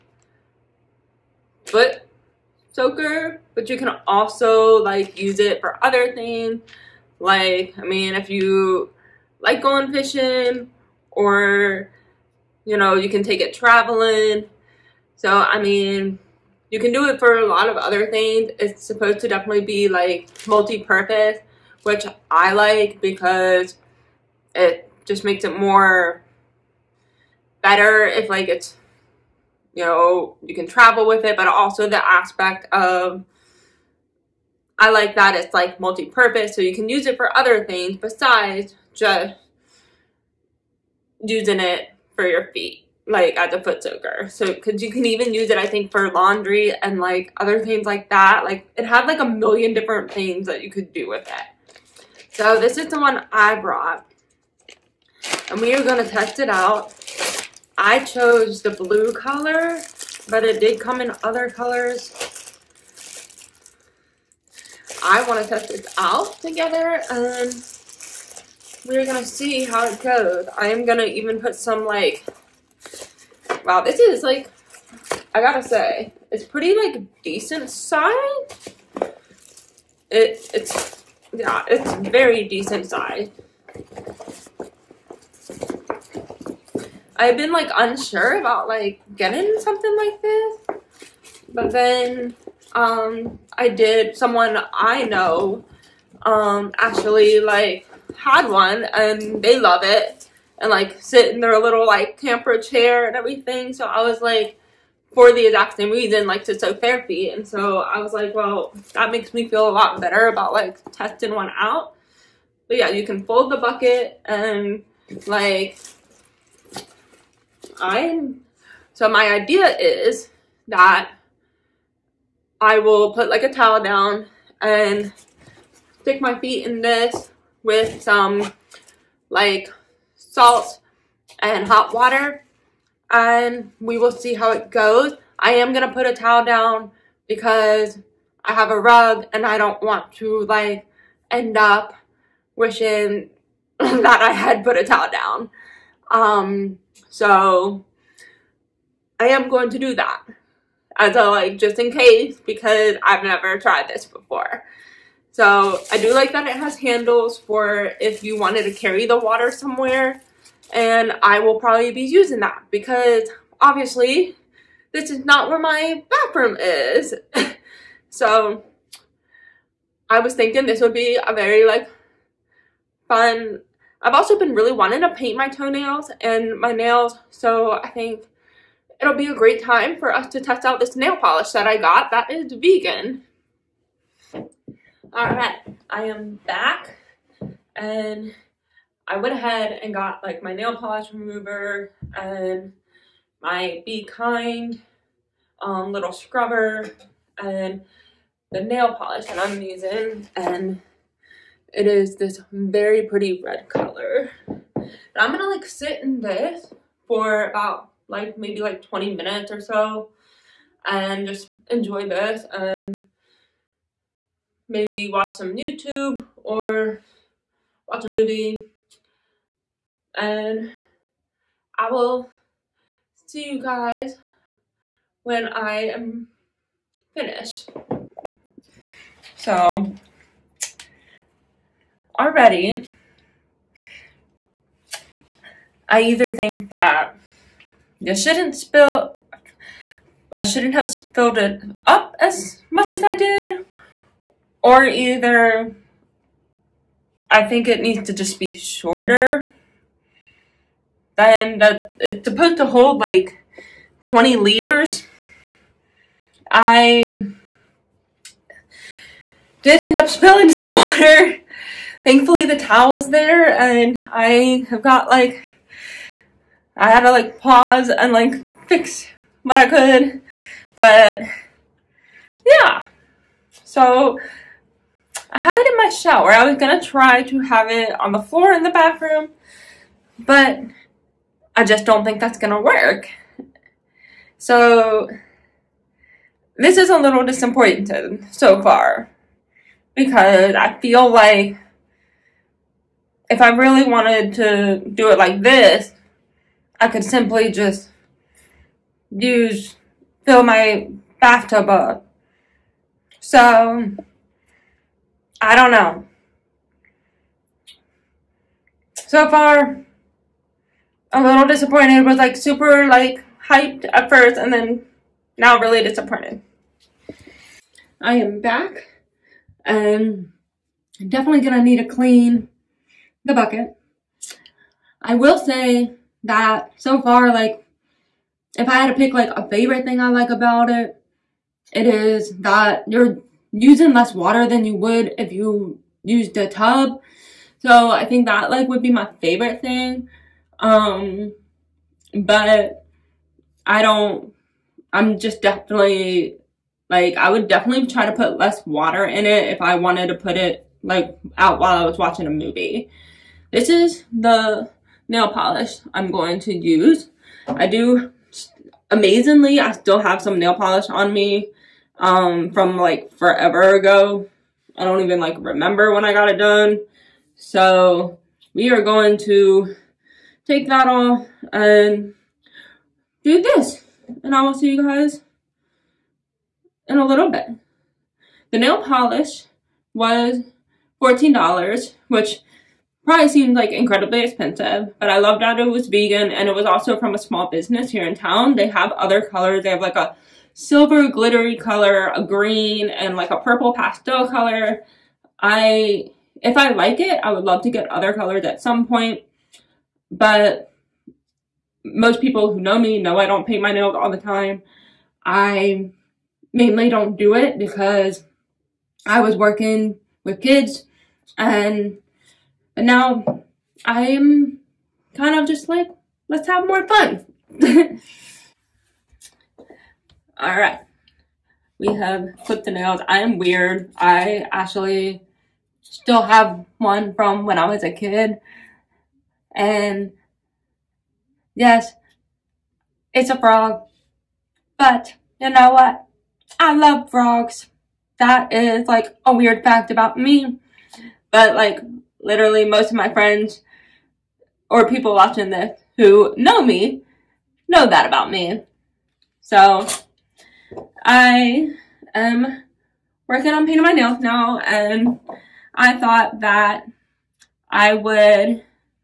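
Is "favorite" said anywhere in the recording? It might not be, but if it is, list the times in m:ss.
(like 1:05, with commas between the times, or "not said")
5:29, 5:39.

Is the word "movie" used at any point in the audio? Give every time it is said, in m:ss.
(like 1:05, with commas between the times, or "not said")
3:38, 5:52.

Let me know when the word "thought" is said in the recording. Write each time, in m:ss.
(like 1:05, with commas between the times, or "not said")
7:35.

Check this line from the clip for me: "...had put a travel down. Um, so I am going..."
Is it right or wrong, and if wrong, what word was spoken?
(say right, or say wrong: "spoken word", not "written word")
wrong: "towel", not "travel".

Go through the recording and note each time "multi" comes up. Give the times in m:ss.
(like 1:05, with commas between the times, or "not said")
0:20, 0:35.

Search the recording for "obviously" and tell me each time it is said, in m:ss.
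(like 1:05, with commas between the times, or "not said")
2:43.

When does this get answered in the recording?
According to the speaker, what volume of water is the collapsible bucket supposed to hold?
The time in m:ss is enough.
4:14.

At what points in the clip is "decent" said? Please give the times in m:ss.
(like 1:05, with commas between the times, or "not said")
1:17, 1:22.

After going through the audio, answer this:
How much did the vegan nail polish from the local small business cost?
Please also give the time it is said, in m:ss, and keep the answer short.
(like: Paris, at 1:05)
$14, at 6:21.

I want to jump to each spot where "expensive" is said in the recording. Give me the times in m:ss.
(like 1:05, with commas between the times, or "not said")
6:24.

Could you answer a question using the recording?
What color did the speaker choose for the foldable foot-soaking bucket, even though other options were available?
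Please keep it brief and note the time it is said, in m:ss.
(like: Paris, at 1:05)
blue, at 0:58.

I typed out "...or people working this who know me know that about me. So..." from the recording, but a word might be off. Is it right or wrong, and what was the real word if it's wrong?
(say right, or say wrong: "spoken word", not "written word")
wrong: "watching", not "working".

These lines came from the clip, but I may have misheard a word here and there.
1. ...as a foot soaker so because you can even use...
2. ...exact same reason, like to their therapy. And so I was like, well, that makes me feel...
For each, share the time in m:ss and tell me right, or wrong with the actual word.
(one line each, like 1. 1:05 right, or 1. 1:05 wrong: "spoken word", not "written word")
1. 0:43 right
2. 1:45 right.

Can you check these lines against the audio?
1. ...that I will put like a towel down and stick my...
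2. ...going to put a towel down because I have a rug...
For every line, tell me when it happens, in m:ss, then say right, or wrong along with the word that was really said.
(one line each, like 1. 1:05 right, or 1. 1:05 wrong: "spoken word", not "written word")
1. 2:00 right
2. 2:15 right.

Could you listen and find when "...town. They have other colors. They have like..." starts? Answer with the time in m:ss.
6:28.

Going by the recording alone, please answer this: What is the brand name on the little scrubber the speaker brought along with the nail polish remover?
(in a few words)
Be Kind.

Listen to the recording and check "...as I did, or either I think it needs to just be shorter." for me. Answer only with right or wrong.
right.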